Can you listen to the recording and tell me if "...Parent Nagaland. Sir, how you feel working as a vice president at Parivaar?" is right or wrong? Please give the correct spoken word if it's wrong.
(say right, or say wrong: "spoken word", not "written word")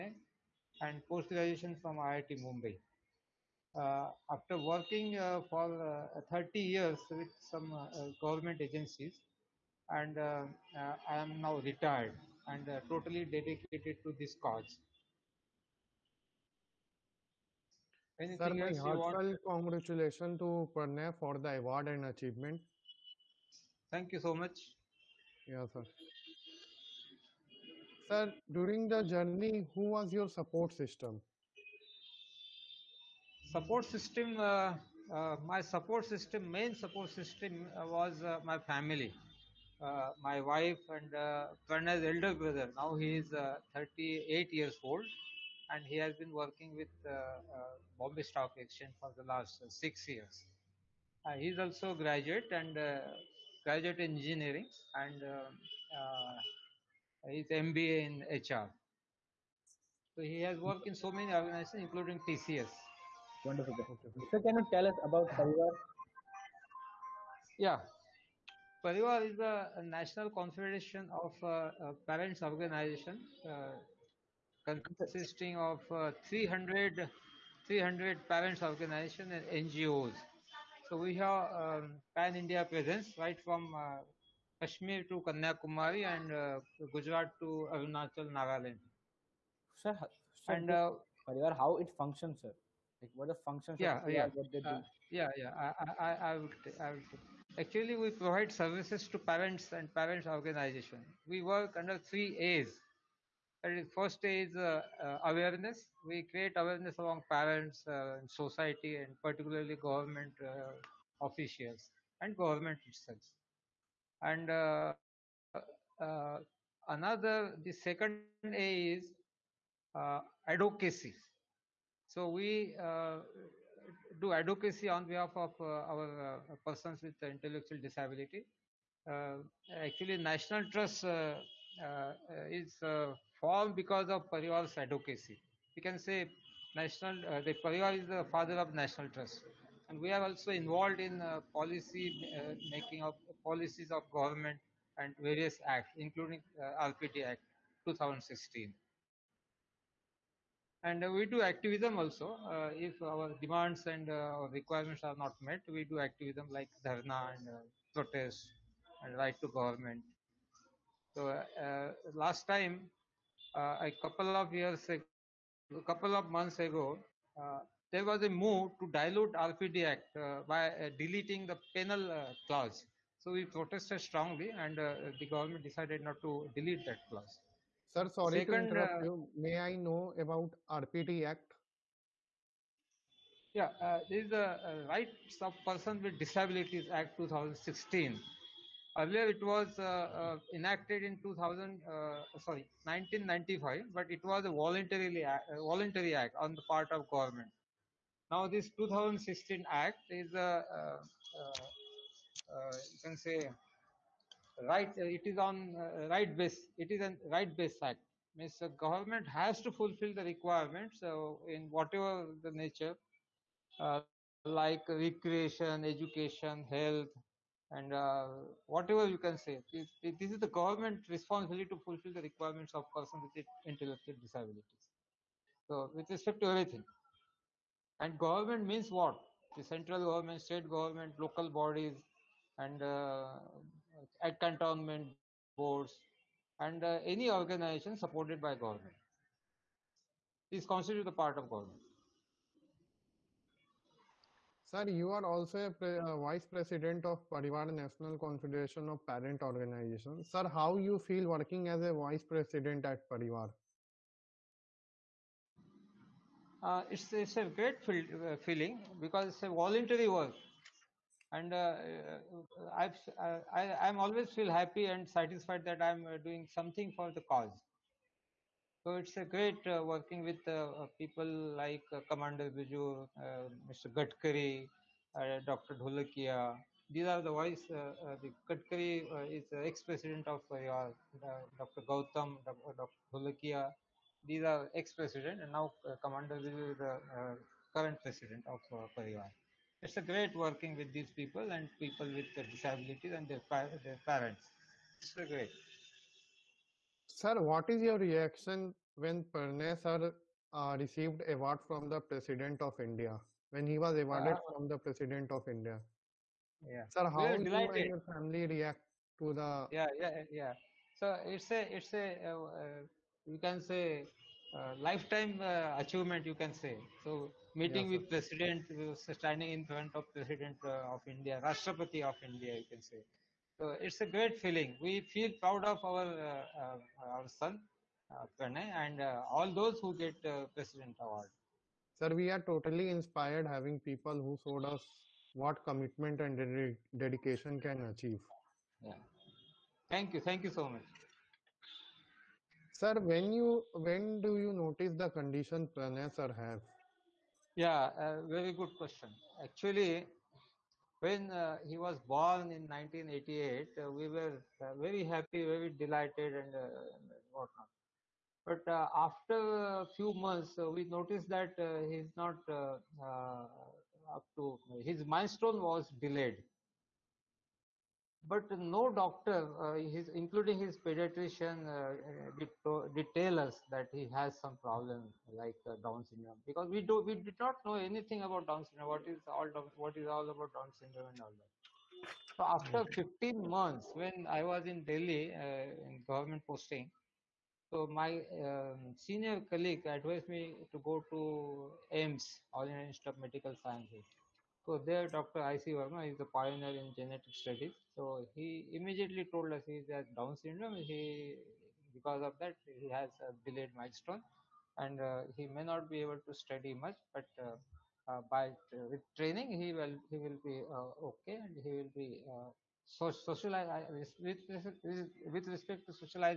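wrong: "Organizations", not "Nagaland".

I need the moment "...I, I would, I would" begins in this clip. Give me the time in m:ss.
1:36.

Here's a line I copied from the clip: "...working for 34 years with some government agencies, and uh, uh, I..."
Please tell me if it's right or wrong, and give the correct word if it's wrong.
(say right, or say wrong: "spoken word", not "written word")
wrong: "30", not "34".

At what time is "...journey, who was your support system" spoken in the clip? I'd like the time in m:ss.
0:29.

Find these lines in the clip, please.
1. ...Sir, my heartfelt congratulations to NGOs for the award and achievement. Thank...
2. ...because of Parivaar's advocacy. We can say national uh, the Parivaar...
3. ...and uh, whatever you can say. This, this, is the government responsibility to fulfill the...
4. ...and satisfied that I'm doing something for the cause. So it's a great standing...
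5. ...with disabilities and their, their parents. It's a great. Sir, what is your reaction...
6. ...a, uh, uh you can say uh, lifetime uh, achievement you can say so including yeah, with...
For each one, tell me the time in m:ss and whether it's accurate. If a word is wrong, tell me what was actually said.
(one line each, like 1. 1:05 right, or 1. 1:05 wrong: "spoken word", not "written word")
1. 0:18 wrong: "Pranay", not "NGOs"
2. 2:13 right
3. 3:37 right
4. 4:24 wrong: "working", not "standing"
5. 4:52 right
6. 5:11 wrong: "meeting", not "including".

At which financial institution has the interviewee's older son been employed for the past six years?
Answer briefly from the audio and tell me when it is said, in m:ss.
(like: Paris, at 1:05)
Bombay Stock Exchange, at 0:47.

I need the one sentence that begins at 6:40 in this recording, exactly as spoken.
He, because of that, he has a delayed milestone, and uh, he may not be able to study much.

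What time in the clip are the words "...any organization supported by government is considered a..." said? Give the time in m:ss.
3:57.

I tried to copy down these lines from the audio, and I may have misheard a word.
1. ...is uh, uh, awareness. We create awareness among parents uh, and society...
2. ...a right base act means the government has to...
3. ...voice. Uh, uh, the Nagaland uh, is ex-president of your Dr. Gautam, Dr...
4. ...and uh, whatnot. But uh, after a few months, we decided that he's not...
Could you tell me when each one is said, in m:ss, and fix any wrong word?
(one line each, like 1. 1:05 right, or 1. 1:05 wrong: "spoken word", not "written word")
1. 1:44 right
2. 3:26 right
3. 4:37 wrong: "Gadkari", not "Nagaland"
4. 5:56 wrong: "noticed", not "decided".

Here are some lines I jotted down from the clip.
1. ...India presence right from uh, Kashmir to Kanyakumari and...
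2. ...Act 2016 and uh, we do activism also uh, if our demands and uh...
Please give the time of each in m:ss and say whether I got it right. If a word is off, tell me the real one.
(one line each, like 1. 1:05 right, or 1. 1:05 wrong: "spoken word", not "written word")
1. 1:22 right
2. 2:27 right.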